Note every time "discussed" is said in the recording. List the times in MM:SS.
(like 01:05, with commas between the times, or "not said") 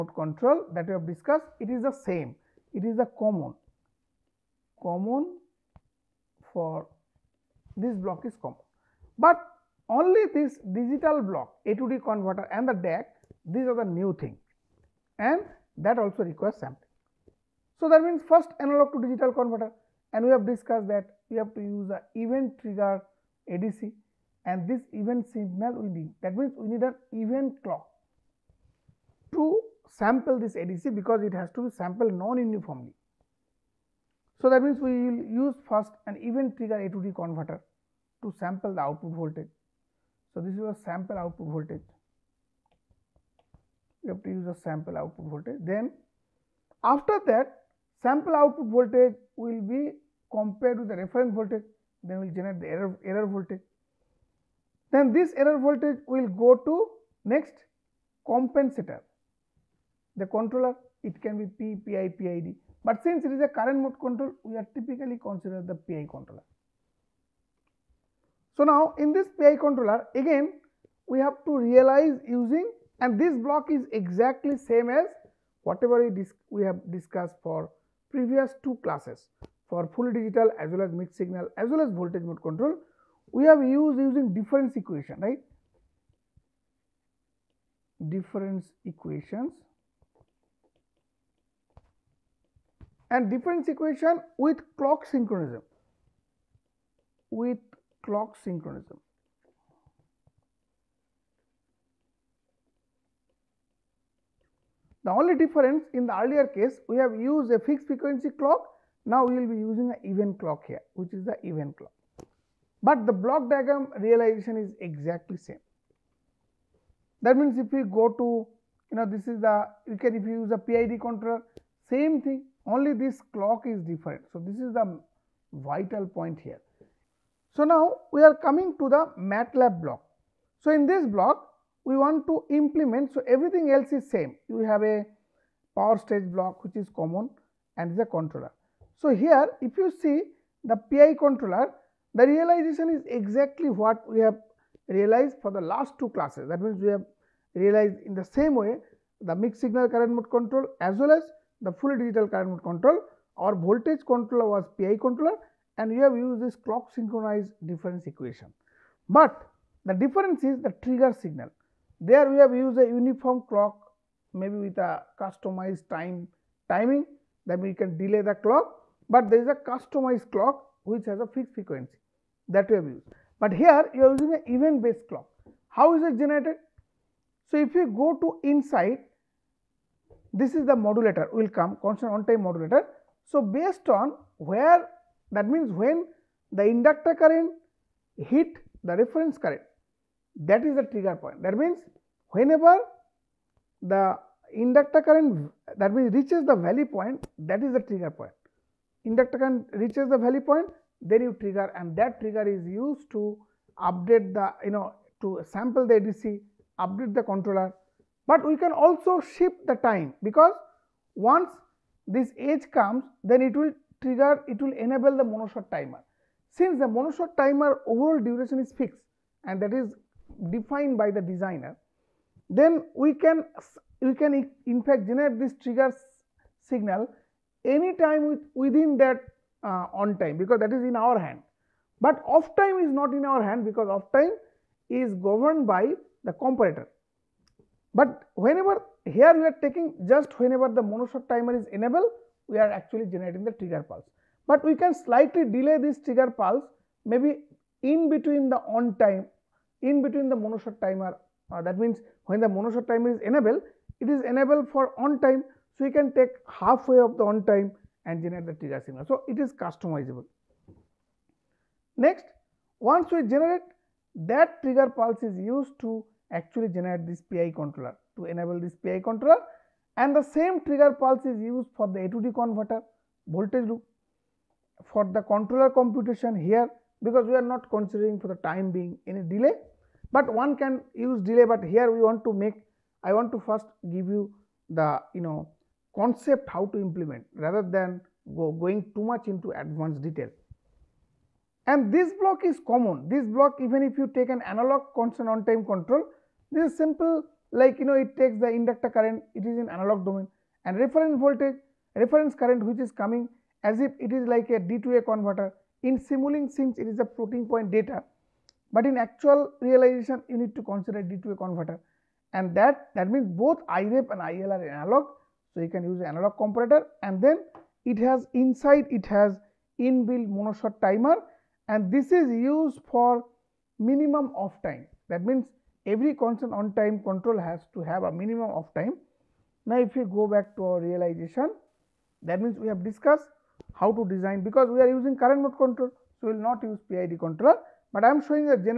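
00:01, 00:20, 01:16, 05:32.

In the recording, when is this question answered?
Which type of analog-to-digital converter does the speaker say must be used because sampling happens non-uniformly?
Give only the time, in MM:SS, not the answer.
00:22.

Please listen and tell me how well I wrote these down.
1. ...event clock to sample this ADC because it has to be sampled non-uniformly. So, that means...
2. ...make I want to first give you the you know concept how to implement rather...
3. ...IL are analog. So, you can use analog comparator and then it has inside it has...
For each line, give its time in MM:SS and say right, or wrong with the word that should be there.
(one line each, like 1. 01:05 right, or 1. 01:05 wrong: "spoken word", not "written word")
1. 00:27 right
2. 04:42 right
3. 05:14 right.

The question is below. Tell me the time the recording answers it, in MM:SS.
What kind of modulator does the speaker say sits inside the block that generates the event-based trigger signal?
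03:01.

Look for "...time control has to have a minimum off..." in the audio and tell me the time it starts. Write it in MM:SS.
05:26.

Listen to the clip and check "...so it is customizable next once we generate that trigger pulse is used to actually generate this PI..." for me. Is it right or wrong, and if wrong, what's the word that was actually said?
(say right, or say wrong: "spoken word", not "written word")
right.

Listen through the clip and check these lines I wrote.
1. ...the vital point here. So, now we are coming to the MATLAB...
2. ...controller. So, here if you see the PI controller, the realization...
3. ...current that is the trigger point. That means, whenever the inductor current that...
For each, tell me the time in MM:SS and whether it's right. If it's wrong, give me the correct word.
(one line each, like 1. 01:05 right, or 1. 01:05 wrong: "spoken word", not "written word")
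1. 02:04 right
2. 02:18 right
3. 03:09 right.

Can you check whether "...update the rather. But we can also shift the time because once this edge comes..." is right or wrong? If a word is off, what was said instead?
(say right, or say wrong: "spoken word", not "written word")
wrong: "controller", not "rather".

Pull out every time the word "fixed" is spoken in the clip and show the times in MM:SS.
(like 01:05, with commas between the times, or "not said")
01:47, 02:51, 03:38.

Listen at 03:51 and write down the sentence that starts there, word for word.
But off time is not in our hand because off time is governed by the comparator.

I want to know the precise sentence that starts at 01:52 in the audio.
But the block diagram realization is exactly same.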